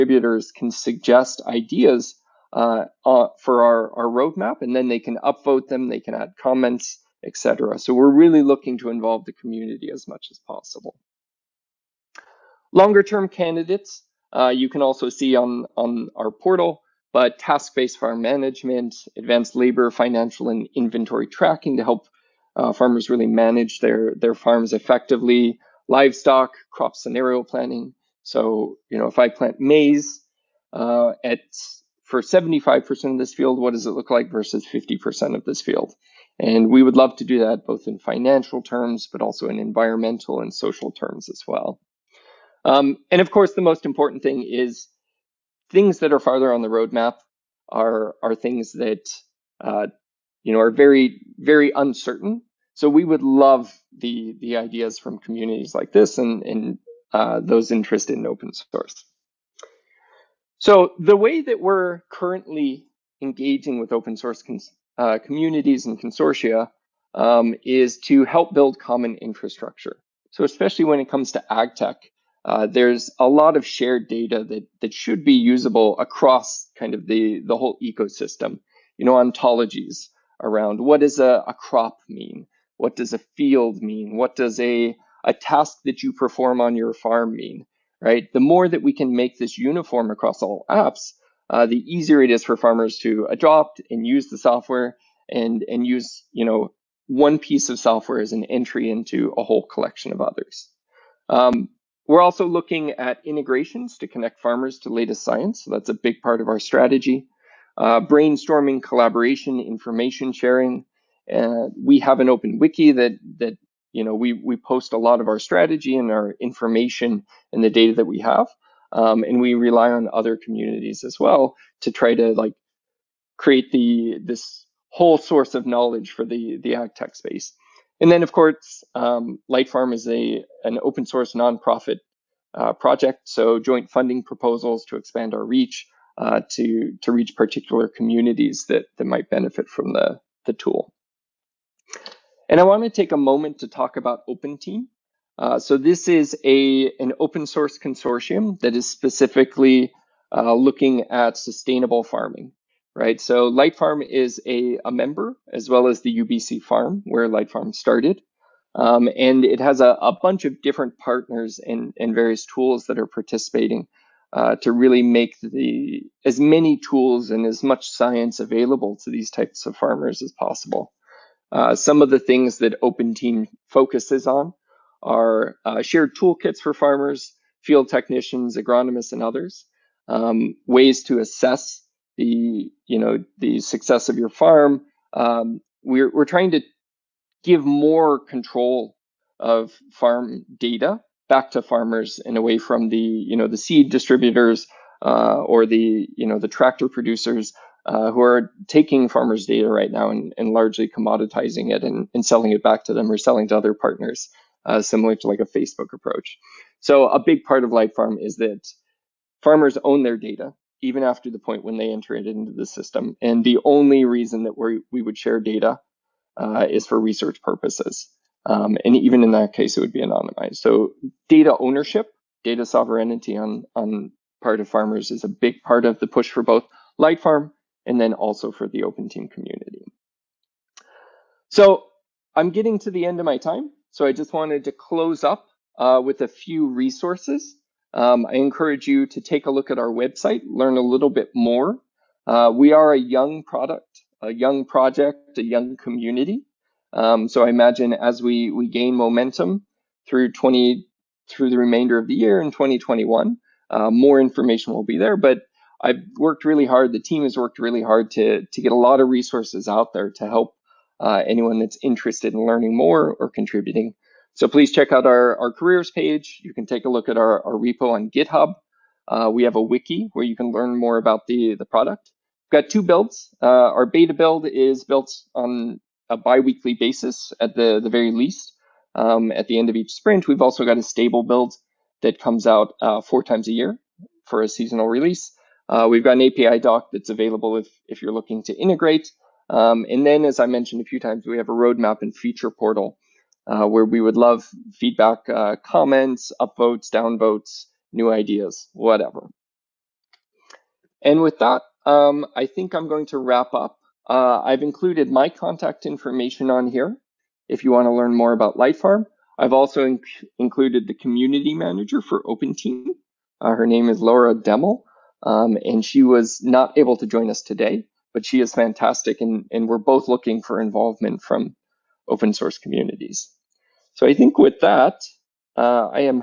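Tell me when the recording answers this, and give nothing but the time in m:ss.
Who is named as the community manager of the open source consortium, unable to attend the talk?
5:13.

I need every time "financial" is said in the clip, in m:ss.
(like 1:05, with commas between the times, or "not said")
0:19, 0:37.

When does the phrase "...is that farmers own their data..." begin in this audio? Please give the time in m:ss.
3:28.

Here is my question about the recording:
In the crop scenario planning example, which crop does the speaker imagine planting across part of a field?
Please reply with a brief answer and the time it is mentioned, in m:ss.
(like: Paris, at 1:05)
Maize, at 0:29.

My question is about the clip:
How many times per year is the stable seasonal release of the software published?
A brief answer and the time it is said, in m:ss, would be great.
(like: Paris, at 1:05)
4, at 4:43.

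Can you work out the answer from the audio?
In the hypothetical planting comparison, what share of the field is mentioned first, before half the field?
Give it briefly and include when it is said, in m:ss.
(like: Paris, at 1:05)
75%, at 0:32.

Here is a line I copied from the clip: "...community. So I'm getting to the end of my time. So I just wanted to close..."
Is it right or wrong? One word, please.
right.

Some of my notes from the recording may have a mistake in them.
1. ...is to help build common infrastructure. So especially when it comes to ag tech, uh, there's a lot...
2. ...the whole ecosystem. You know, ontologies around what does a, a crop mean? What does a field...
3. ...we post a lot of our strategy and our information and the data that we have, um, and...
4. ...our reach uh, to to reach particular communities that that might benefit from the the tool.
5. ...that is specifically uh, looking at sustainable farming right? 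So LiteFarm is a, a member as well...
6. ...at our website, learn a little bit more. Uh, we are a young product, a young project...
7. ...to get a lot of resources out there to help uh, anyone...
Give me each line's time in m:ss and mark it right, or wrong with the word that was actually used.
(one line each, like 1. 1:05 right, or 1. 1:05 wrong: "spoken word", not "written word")
1. 1:07 right
2. 1:17 right
3. 1:54 right
4. 2:15 right
5. 2:28 right
6. 3:59 right
7. 4:18 right.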